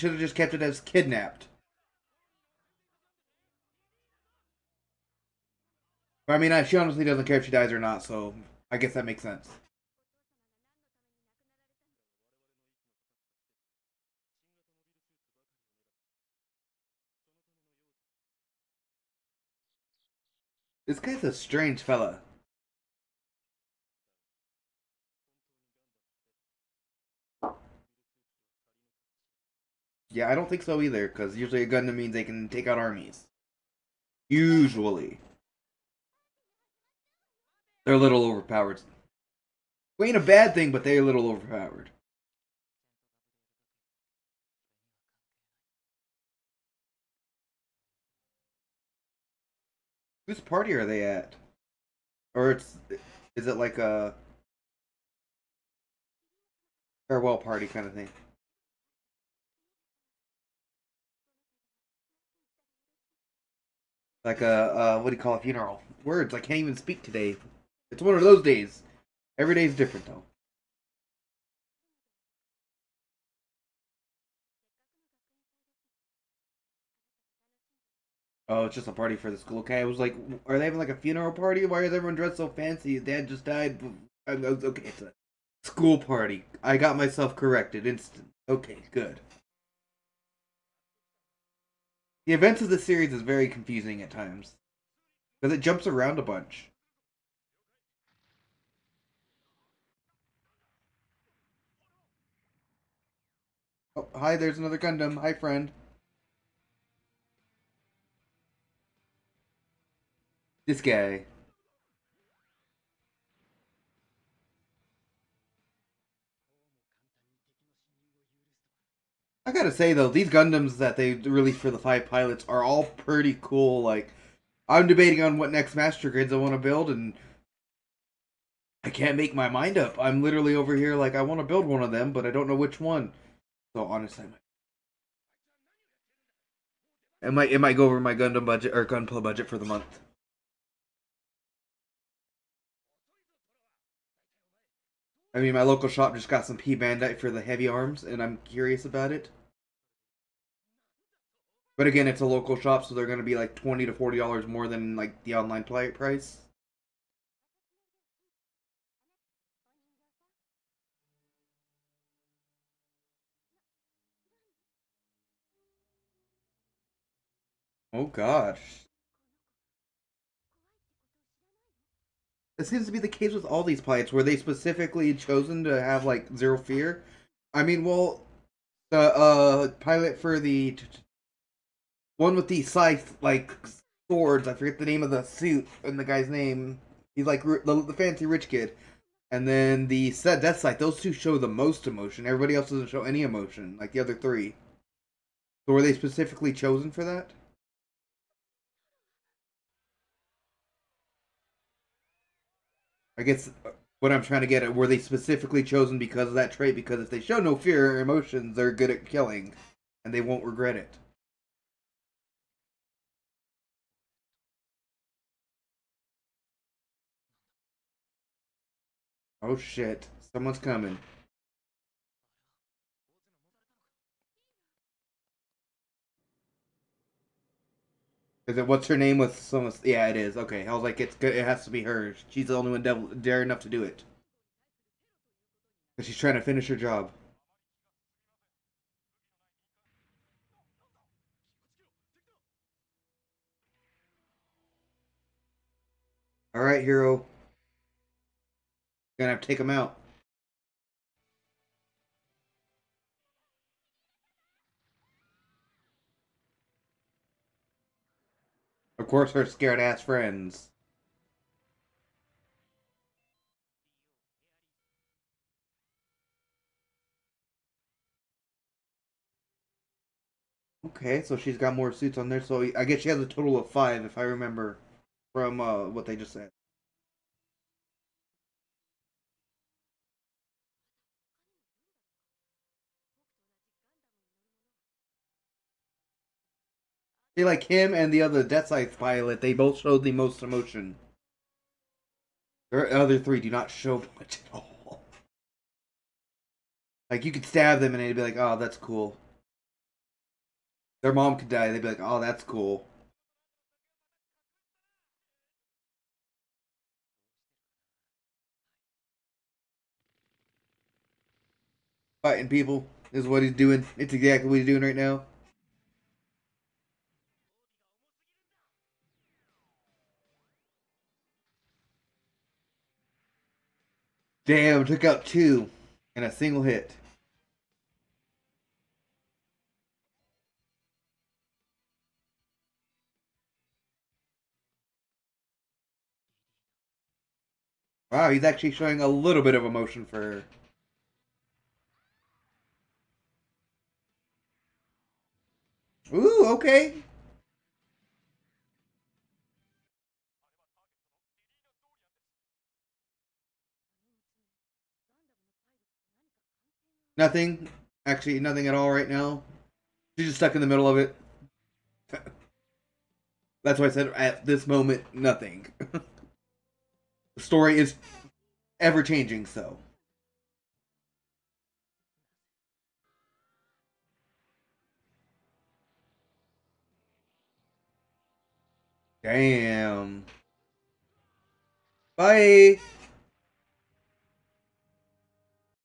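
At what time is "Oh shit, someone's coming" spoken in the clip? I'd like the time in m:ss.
3:39.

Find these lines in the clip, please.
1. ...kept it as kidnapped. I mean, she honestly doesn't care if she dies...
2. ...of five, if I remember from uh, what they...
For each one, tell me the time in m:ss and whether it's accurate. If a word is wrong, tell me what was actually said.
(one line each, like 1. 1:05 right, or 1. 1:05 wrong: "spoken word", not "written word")
1. 0:00 right
2. 4:33 right.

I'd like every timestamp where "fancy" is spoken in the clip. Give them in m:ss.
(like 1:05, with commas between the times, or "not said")
1:22, 3:07.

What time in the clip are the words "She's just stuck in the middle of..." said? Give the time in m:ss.
6:00.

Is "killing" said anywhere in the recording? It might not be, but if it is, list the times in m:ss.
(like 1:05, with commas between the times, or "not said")
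3:29.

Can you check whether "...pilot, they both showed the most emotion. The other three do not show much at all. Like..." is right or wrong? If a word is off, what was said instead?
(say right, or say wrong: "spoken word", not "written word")
right.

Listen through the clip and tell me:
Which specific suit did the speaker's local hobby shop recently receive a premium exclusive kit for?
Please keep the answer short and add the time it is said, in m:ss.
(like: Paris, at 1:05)
Heavyarms, at 2:27.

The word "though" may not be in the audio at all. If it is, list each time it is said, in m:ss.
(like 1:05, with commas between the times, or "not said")
1:10, 1:59.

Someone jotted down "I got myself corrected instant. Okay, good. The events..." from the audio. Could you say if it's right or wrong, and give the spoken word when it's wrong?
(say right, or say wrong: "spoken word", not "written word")
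right.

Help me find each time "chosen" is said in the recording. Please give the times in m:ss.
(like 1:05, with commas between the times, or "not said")
2:55, 3:16, 3:25.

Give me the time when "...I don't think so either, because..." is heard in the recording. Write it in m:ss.
0:30.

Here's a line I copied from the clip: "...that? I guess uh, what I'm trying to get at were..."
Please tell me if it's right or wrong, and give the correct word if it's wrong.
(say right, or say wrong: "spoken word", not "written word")
right.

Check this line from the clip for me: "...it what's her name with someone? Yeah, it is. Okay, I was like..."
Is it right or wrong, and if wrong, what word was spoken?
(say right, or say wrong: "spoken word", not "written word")
right.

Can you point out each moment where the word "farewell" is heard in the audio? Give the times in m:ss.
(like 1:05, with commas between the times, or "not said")
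0:57.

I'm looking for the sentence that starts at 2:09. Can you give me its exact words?
I'm literally over here like I want to build one of them, but I don't know which one.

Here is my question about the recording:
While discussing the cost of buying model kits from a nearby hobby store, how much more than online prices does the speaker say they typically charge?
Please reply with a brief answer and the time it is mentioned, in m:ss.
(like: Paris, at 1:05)
$20 to $40, at 2:33.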